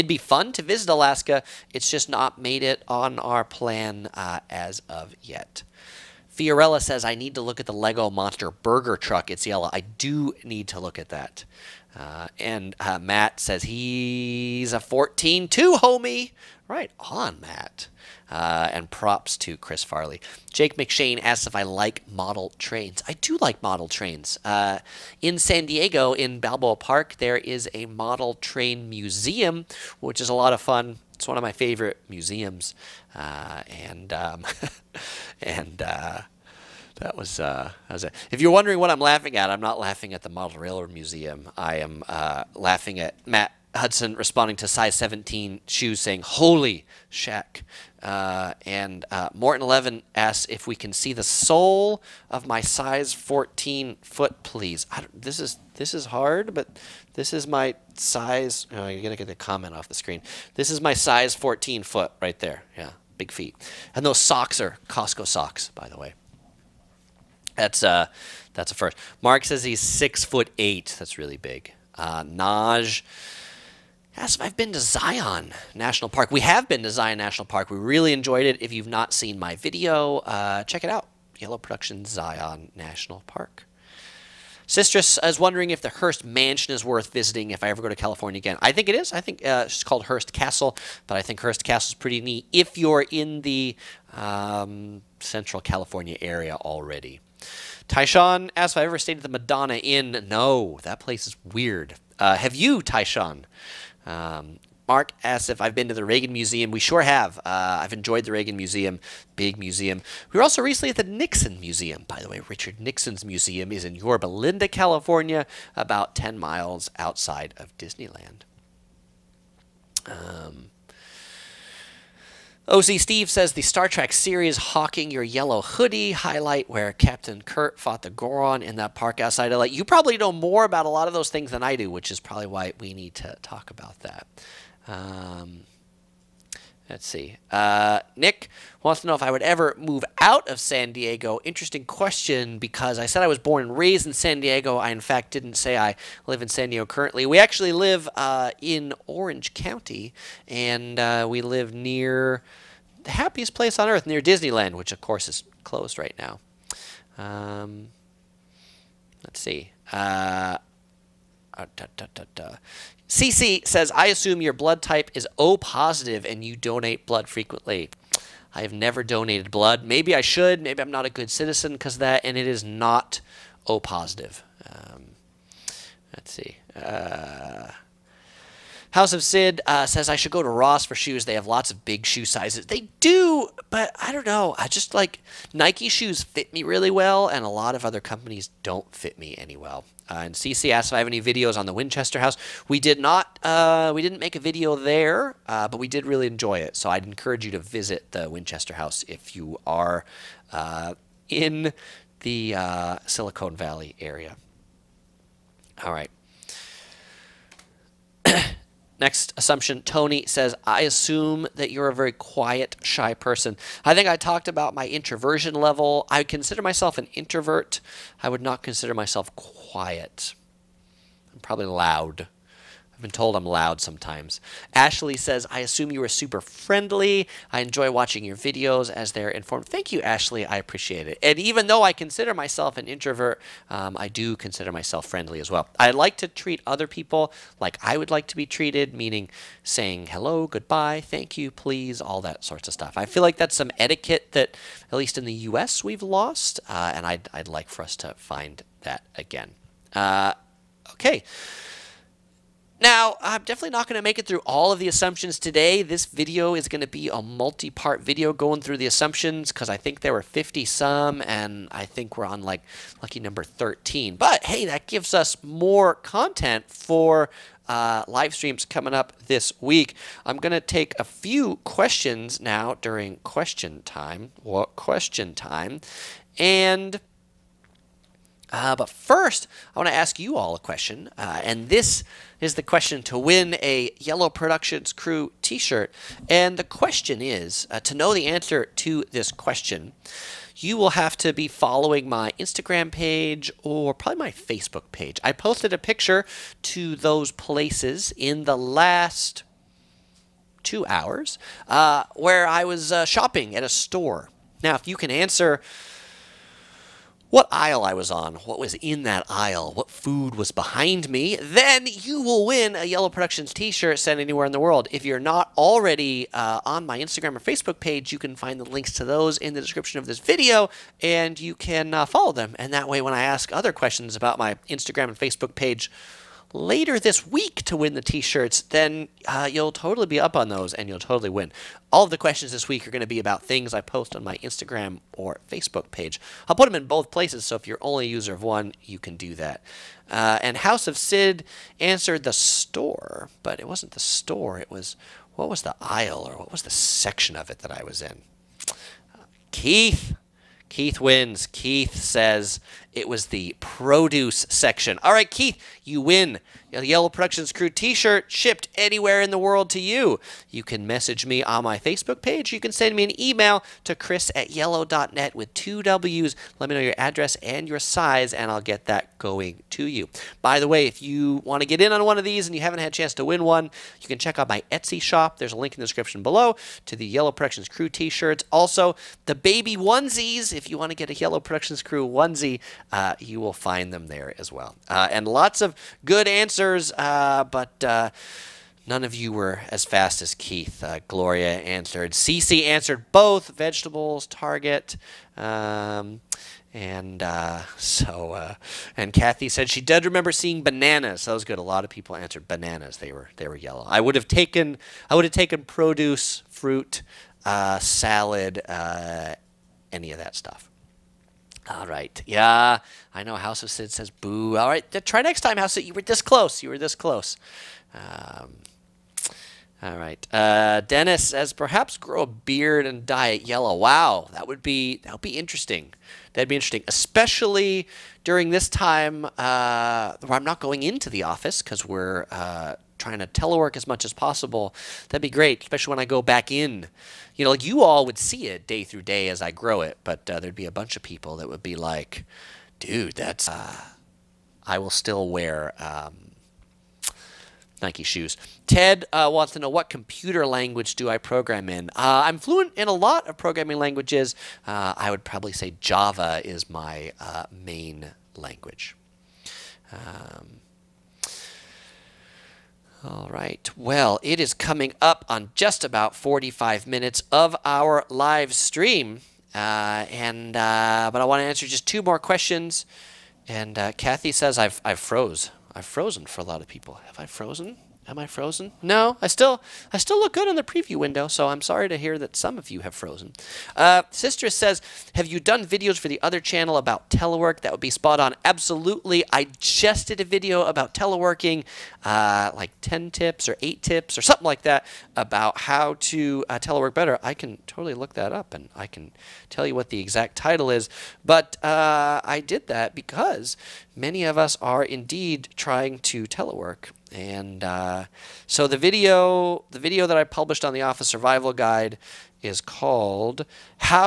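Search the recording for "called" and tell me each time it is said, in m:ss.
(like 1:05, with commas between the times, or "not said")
1:29, 8:32.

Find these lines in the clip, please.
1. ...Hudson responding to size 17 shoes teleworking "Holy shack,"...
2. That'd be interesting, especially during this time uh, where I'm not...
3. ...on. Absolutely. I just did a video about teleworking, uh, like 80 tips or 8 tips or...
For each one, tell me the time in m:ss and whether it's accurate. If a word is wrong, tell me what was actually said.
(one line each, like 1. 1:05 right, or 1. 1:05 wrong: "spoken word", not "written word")
1. 0:43 wrong: "saying", not "teleworking"
2. 7:06 right
3. 8:08 wrong: "10", not "80".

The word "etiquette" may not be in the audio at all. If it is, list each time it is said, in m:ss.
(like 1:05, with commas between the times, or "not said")
4:03.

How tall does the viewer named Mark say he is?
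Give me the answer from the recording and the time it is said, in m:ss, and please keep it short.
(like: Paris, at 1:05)
6 foot 8, at 1:09.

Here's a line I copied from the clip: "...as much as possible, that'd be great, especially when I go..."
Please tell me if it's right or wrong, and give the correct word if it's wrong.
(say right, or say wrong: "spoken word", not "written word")
right.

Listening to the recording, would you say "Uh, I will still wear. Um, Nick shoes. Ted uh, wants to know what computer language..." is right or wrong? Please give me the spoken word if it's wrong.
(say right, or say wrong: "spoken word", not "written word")
wrong: "Nike", not "Nick".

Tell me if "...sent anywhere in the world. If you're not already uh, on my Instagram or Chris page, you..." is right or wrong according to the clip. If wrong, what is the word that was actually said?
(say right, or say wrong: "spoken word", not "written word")
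wrong: "Facebook", not "Chris".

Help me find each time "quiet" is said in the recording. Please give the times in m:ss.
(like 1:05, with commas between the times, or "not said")
3:32, 3:39.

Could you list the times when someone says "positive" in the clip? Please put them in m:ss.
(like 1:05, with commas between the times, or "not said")
2:45, 2:53.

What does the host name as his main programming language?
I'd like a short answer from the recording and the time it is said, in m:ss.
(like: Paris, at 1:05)
Java, at 7:35.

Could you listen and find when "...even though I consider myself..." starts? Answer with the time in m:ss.
3:51.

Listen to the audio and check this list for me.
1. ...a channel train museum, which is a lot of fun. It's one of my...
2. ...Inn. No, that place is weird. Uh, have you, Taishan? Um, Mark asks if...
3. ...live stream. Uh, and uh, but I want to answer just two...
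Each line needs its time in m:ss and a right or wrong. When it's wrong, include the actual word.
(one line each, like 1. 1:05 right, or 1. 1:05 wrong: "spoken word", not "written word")
1. 0:27 wrong: "model", not "channel"
2. 1:39 right
3. 7:48 right.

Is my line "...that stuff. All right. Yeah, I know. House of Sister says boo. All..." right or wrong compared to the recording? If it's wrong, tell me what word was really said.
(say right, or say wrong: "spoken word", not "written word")
wrong: "Sid", not "Sister".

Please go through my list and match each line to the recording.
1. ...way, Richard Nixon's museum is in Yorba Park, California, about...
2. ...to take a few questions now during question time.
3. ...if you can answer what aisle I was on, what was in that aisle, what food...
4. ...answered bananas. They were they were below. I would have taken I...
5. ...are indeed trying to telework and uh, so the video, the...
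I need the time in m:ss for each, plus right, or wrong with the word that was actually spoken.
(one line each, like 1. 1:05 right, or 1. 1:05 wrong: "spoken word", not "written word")
1. 1:52 wrong: "Linda", not "Park"
2. 4:30 right
3. 5:04 right
4. 6:42 wrong: "yellow", not "below"
5. 8:24 right.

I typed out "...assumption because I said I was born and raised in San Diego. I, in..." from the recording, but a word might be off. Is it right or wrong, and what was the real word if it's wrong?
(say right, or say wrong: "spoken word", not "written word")
wrong: "question", not "assumption".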